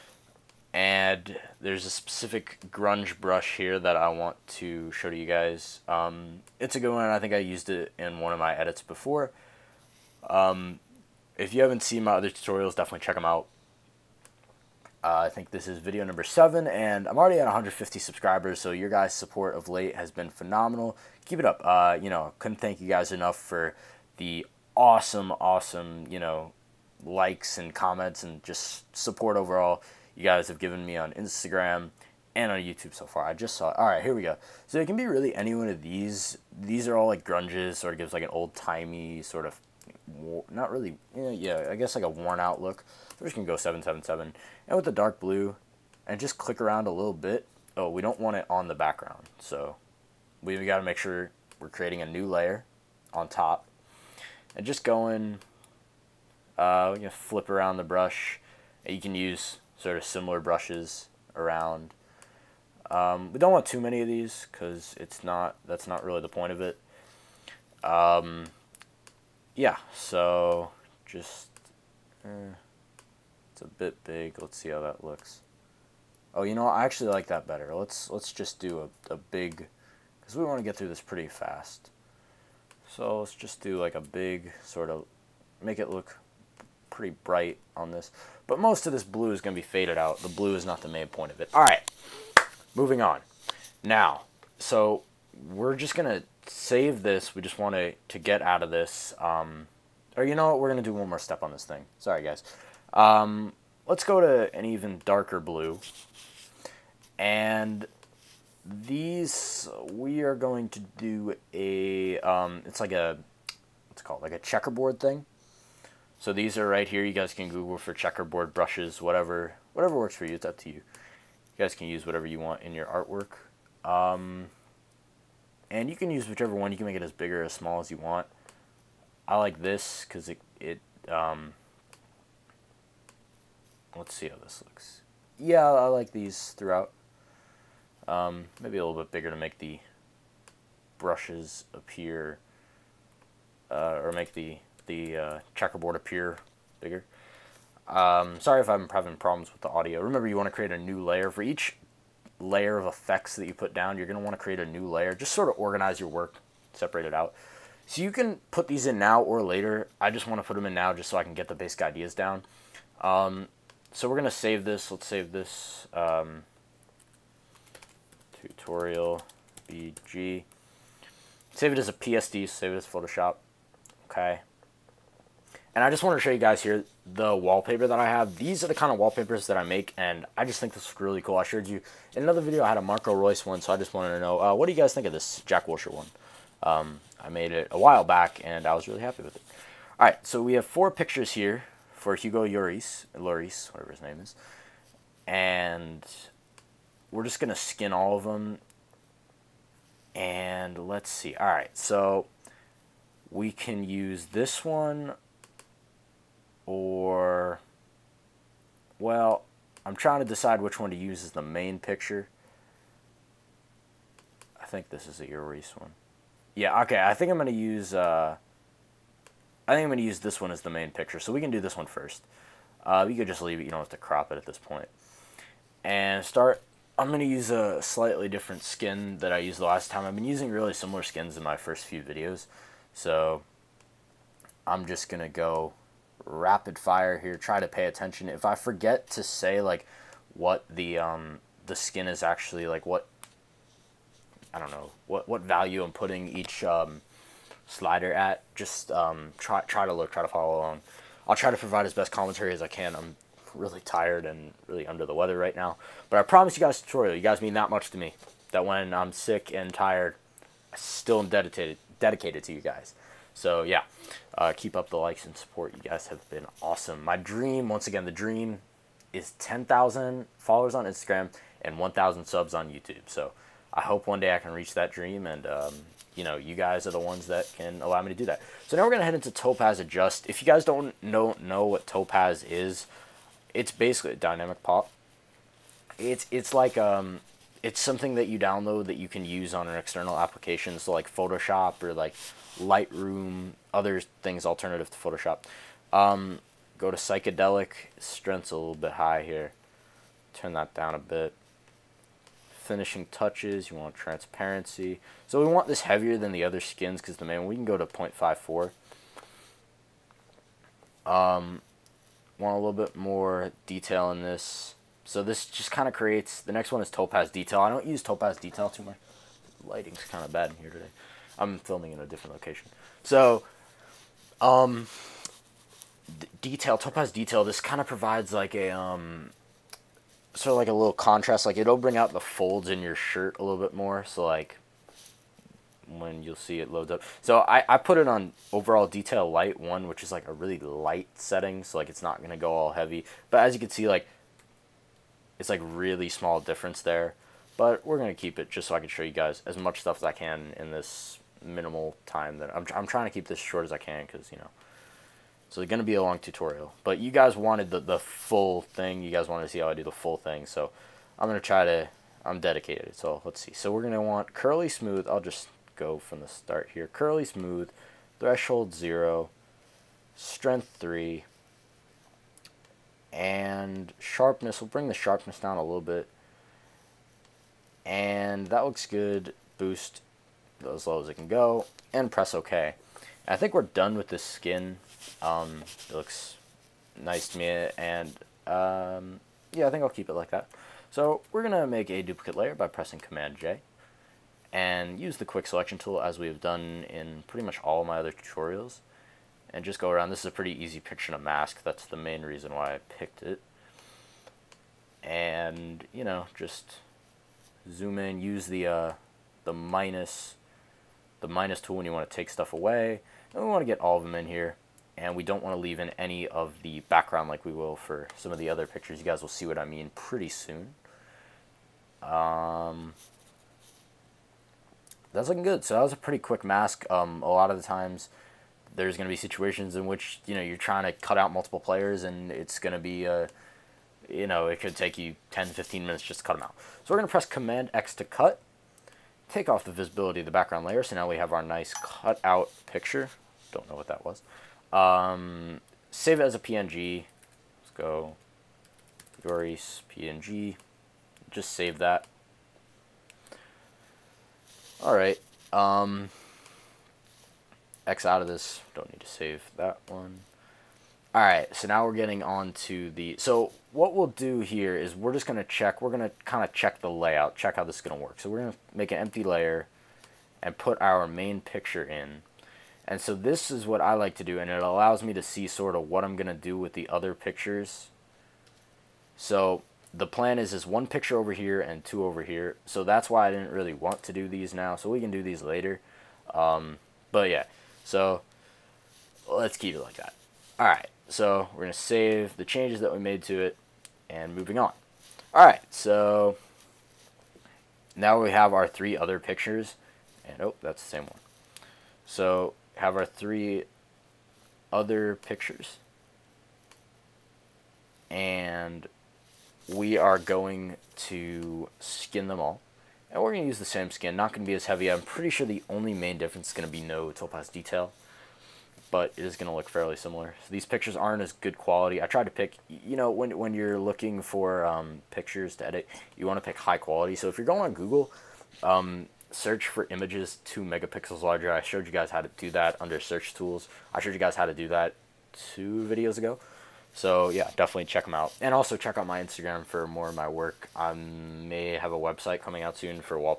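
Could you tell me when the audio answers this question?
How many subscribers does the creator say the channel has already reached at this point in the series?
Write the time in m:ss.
0:17.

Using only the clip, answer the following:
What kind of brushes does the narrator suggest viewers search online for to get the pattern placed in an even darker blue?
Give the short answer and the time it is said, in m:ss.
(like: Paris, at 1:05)
Checkerboard brushes, at 1:57.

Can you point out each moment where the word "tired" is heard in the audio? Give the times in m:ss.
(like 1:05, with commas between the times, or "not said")
4:13, 4:19.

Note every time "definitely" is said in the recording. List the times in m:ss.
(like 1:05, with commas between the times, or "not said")
0:12, 8:57.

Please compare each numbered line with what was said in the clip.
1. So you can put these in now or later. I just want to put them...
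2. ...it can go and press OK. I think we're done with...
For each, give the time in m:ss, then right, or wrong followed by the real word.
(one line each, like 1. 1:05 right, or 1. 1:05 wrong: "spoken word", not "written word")
1. 2:37 right
2. 6:21 right.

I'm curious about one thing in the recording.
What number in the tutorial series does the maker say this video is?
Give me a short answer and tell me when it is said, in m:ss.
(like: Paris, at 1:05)
7, at 0:15.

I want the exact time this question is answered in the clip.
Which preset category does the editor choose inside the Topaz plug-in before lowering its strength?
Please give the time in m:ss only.
4:56.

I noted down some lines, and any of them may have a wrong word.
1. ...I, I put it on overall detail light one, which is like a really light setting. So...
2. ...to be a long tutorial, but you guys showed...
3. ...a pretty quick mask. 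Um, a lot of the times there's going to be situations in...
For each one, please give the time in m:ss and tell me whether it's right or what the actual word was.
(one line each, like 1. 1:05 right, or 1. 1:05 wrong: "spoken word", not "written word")
1. 5:37 right
2. 5:55 wrong: "wanted", not "showed"
3. 7:05 right.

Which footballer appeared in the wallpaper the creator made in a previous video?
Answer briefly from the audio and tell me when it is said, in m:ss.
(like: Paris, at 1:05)
Marco Reus, at 3:02.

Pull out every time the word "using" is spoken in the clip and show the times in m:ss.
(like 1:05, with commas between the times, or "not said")
3:50.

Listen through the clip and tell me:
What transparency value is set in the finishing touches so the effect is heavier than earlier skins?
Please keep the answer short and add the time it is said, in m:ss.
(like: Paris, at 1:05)
0.54, at 5:07.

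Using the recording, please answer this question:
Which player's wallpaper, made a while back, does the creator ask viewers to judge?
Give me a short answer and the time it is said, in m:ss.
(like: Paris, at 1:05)
Jack Wilshere, at 3:05.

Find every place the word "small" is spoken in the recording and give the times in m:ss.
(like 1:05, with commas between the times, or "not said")
2:07, 5:46.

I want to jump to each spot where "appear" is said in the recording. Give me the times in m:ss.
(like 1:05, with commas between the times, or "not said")
2:21, 2:25.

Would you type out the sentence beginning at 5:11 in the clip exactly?
Um, want a little bit more detail in this.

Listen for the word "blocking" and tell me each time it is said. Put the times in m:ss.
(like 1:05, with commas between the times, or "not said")
not said.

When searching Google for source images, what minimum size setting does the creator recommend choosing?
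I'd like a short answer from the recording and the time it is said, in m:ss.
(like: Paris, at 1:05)
2 megapixels, at 8:50.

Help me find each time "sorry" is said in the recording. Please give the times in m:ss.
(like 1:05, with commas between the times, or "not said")
1:41, 2:28.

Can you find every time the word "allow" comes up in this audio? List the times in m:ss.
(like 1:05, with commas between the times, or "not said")
4:37, 7:54.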